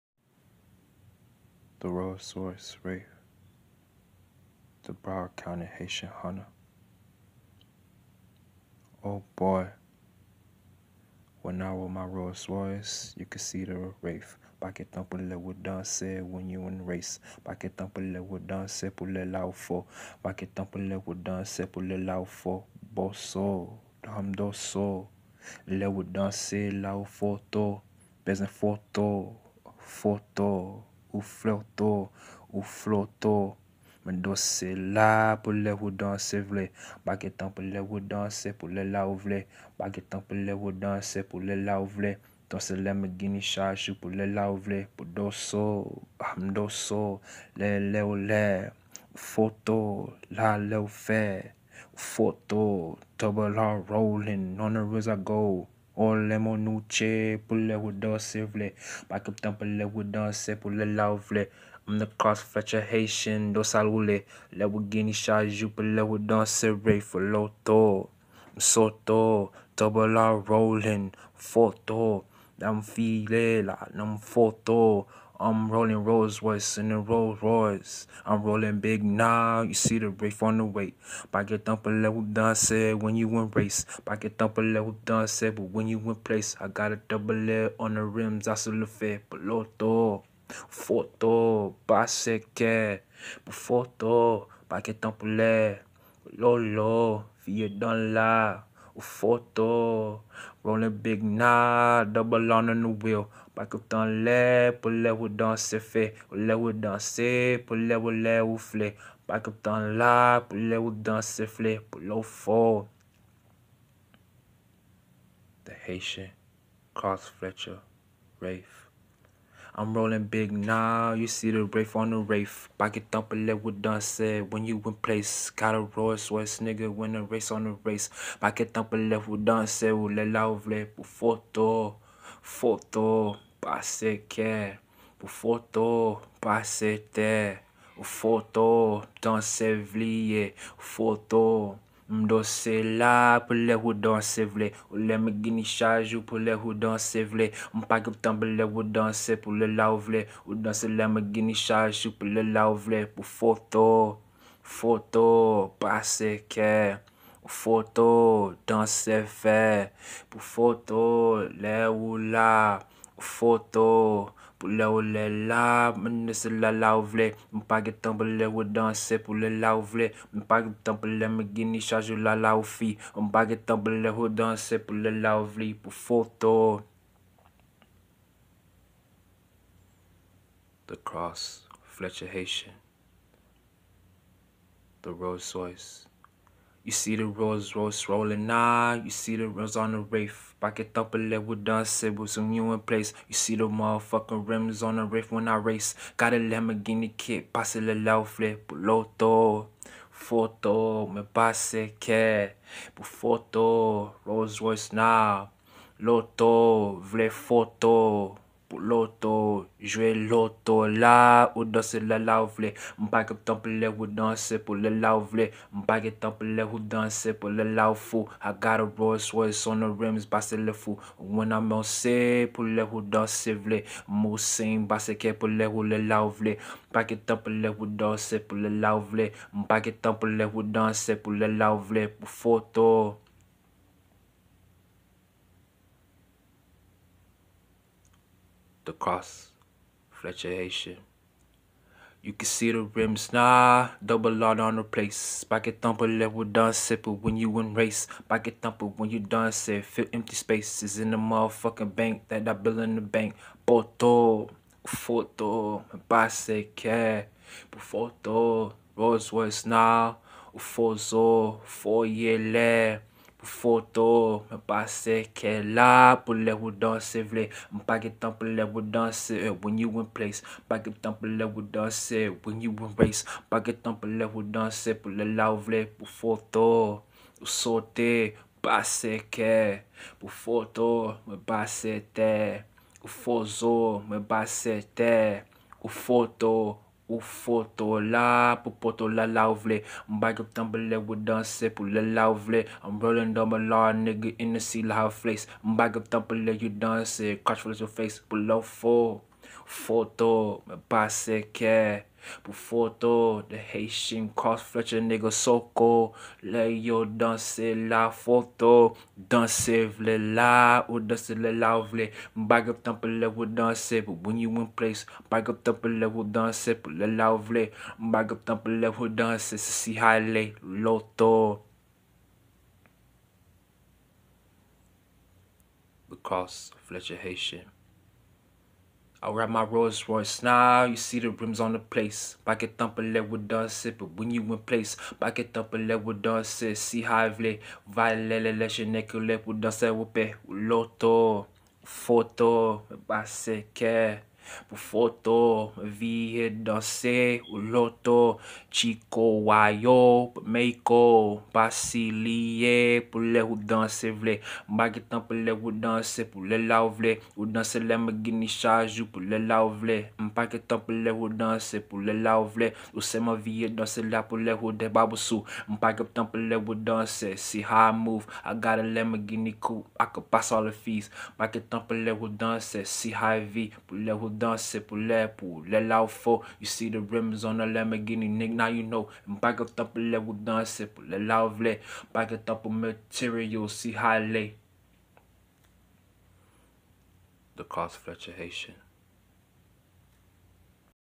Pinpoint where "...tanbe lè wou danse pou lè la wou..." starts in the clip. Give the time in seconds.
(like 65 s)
148 s.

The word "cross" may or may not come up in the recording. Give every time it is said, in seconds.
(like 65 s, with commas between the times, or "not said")
62 s, 181 s, 238 s, 304 s.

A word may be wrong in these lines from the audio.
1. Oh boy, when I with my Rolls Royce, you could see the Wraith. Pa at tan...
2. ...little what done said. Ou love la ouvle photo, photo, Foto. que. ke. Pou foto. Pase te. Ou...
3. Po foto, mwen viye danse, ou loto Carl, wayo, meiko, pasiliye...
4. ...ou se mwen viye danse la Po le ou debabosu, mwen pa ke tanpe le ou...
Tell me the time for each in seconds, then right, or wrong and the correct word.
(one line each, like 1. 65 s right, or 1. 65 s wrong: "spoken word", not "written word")
1. 9 s right
2. 128 s right
3. 344 s wrong: "Chiko", not "Carl"
4. 362 s right.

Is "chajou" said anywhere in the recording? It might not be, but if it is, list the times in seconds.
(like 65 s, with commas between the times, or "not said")
145 s, 151 s, 171 s, 358 s.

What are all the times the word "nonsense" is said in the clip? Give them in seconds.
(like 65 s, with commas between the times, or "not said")
not said.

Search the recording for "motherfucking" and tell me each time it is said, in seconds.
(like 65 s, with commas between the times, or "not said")
193 s, 251 s.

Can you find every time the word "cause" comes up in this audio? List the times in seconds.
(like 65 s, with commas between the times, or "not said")
not said.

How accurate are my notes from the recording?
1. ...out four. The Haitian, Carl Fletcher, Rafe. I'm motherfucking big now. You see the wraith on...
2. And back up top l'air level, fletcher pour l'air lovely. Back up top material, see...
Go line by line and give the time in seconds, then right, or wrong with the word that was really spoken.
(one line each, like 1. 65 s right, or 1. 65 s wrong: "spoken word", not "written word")
1. 112 s wrong: "rolling", not "motherfucking"
2. 379 s wrong: "danser", not "fletcher".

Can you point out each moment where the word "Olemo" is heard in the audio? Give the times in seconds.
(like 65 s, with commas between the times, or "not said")
55 s.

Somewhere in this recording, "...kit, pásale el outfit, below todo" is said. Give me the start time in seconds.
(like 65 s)
197 s.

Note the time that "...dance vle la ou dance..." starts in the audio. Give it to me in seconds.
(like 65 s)
309 s.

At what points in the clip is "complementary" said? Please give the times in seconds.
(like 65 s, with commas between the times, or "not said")
not said.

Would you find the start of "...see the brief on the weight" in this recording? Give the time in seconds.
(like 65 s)
79 s.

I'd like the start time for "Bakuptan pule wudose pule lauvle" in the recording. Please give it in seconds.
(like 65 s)
59 s.